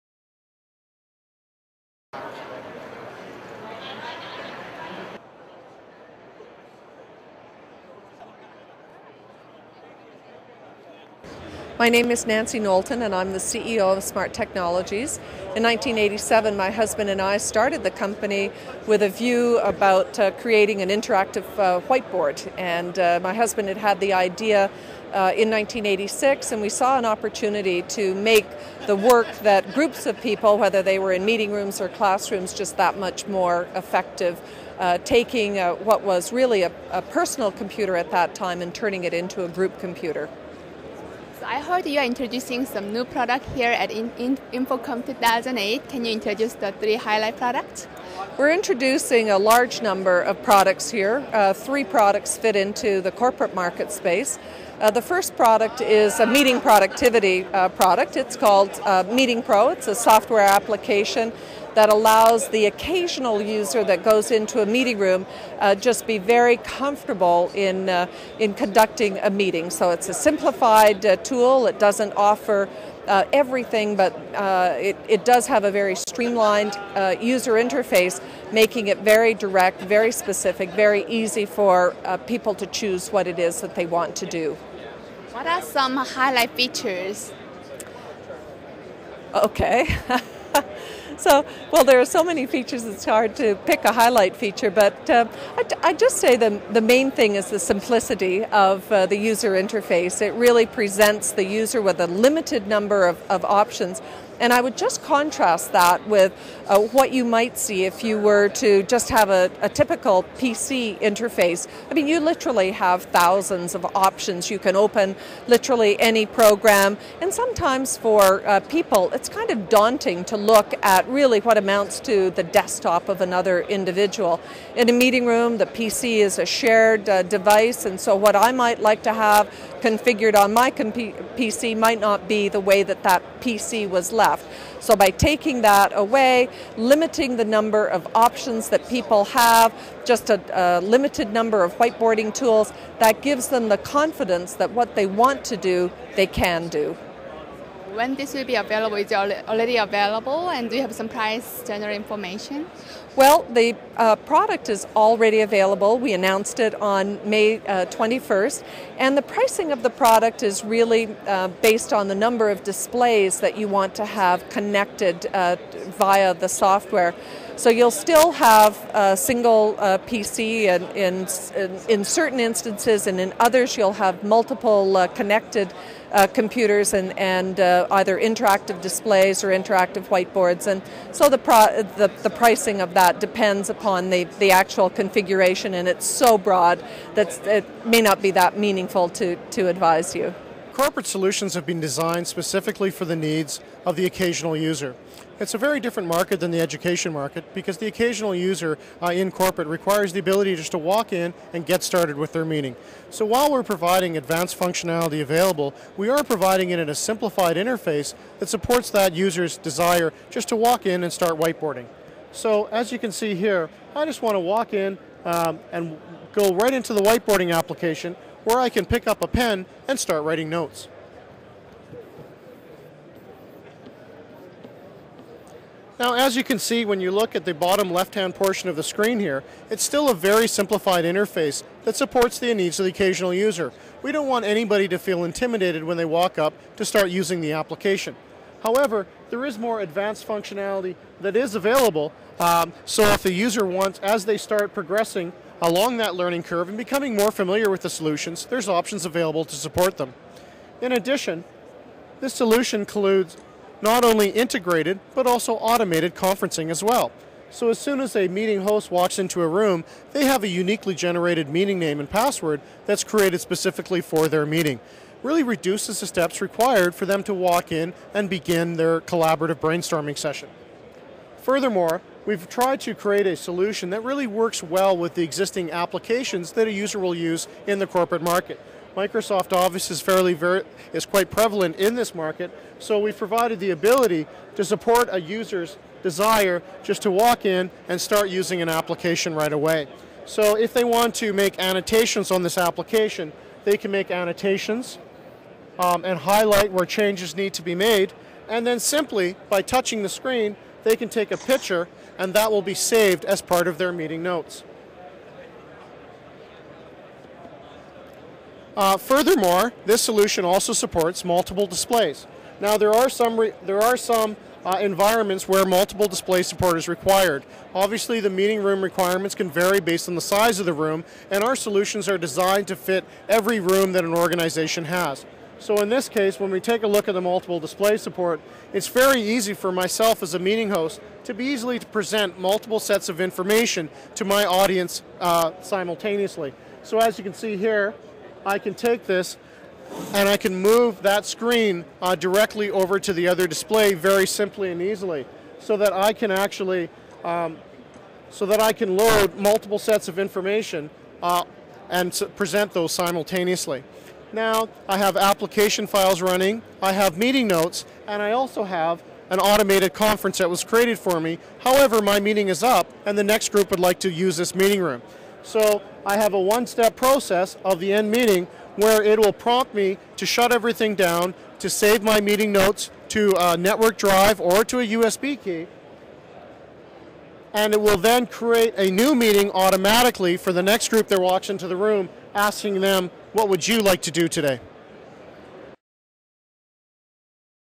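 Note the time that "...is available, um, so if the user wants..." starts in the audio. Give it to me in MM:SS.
04:01.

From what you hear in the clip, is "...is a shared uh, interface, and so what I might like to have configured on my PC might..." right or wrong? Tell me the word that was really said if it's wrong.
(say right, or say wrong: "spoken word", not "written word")
wrong: "device", not "interface".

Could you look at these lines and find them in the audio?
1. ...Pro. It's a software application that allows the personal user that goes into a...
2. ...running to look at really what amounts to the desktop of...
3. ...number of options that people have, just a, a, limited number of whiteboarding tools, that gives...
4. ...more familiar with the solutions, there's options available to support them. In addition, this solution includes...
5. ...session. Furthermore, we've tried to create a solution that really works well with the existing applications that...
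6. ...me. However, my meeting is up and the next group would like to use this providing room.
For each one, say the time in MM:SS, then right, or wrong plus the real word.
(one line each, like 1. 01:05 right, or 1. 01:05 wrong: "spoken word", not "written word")
1. 00:59 wrong: "occasional", not "personal"
2. 01:59 wrong: "daunting", not "running"
3. 02:17 right
4. 04:07 right
5. 04:30 right
6. 06:01 wrong: "meeting", not "providing".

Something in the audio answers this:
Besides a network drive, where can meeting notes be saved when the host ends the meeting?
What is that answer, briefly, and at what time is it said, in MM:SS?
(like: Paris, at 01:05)
USB key, at 06:14.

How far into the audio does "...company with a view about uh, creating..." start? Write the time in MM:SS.
00:17.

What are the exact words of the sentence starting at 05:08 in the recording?
Uh, furthermore, this solution also supports multiple displays.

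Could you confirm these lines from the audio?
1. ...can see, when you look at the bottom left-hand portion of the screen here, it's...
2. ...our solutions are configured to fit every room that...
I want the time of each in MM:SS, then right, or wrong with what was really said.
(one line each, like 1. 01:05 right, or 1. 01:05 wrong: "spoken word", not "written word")
1. 03:46 right
2. 05:21 wrong: "designed", not "configured".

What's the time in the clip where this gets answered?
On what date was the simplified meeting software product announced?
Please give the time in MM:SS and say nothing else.
02:37.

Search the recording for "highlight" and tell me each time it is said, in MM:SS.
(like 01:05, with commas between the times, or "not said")
00:46, 01:25, 01:33, 04:56.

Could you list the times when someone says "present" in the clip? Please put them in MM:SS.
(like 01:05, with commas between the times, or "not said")
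01:40, 05:31, 05:52.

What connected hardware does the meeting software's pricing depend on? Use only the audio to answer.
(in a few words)
Number of displays.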